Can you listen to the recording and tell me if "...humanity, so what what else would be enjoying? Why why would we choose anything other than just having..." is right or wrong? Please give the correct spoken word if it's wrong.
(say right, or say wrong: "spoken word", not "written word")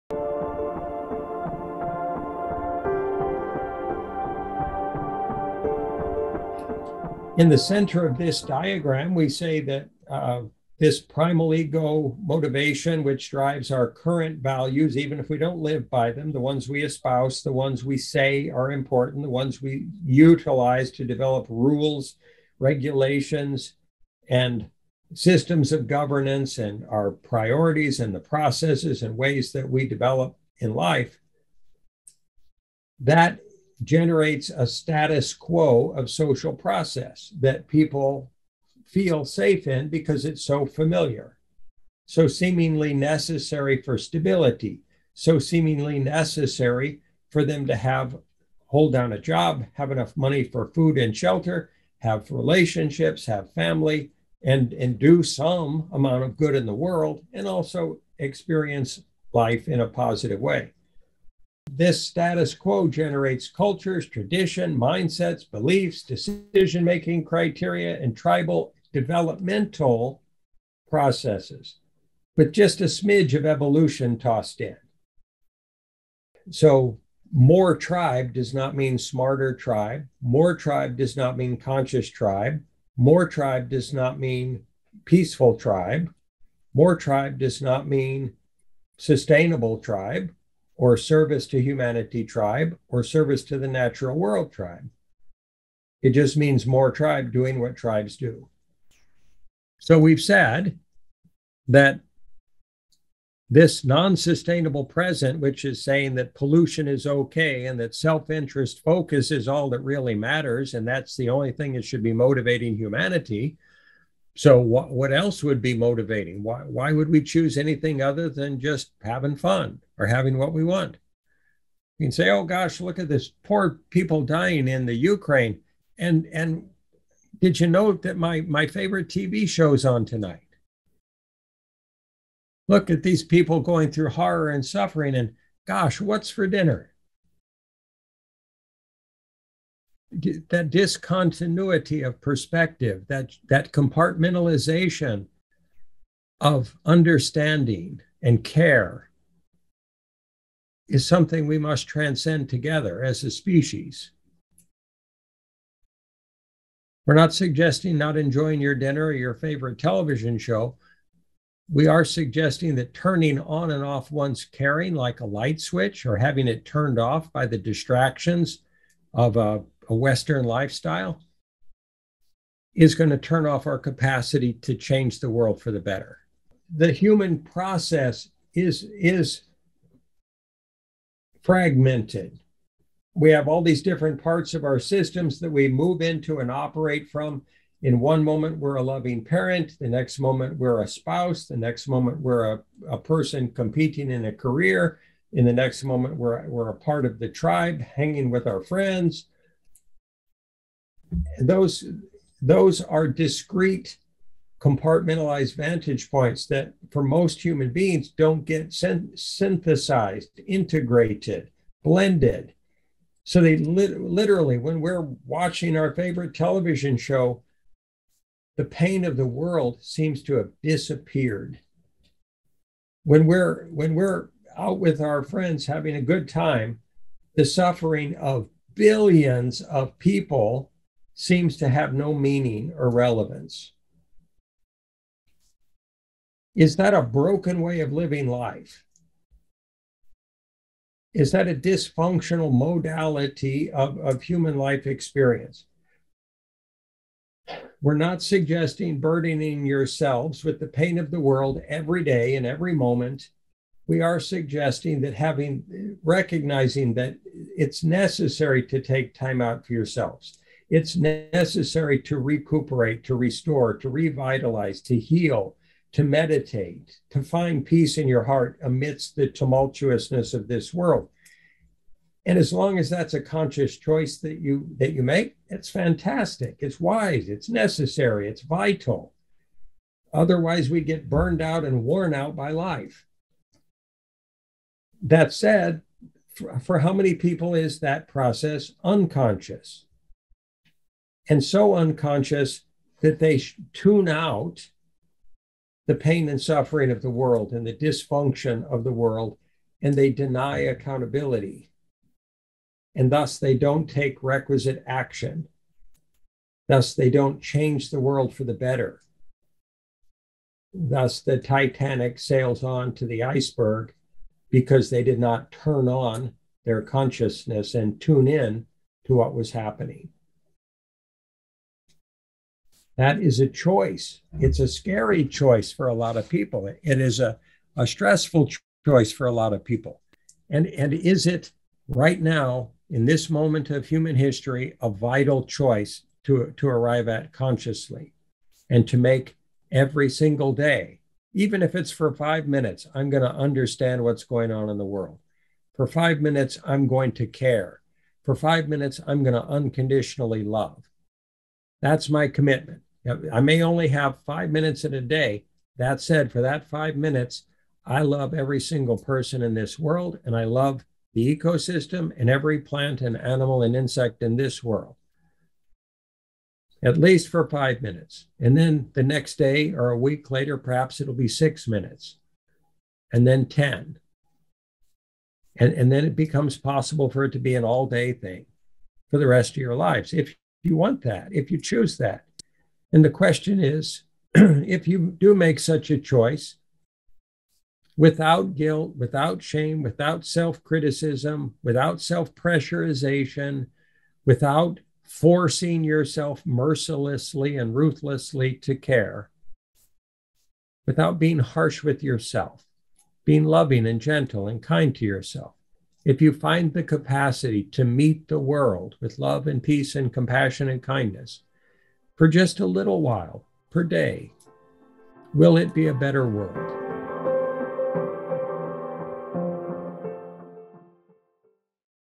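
wrong: "motivating", not "enjoying".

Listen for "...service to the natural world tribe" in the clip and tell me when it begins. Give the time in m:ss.
1:33.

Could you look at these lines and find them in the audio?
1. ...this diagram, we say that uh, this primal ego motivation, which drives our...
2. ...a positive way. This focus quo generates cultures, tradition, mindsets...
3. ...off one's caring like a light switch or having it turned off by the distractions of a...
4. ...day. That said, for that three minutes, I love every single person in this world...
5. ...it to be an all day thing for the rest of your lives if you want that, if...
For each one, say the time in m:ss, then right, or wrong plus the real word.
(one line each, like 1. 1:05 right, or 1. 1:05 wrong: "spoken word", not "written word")
1. 0:08 right
2. 0:59 wrong: "status", not "focus"
3. 2:43 right
4. 5:55 wrong: "five", not "three"
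5. 6:17 right.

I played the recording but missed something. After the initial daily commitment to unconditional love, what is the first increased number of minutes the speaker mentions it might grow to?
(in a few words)
6.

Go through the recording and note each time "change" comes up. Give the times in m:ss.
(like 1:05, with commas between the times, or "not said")
2:54, 5:07.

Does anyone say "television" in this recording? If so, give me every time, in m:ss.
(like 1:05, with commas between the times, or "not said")
2:39, 3:36.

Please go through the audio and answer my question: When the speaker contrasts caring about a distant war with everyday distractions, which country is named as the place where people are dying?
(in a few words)
Ukraine.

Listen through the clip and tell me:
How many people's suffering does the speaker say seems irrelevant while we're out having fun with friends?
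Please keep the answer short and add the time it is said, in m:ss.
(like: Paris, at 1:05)
billions, at 3:48.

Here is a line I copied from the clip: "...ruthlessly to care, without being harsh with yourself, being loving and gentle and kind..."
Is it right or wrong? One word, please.
right.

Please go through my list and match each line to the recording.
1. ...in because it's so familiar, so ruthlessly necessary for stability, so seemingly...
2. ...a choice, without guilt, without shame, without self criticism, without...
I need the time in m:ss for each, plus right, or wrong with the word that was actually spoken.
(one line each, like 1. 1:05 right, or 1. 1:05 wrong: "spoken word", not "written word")
1. 0:39 wrong: "seemingly", not "ruthlessly"
2. 6:25 right.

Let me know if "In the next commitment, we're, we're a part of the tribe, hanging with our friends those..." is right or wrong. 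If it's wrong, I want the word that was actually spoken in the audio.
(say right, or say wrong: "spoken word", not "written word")
wrong: "moment", not "commitment".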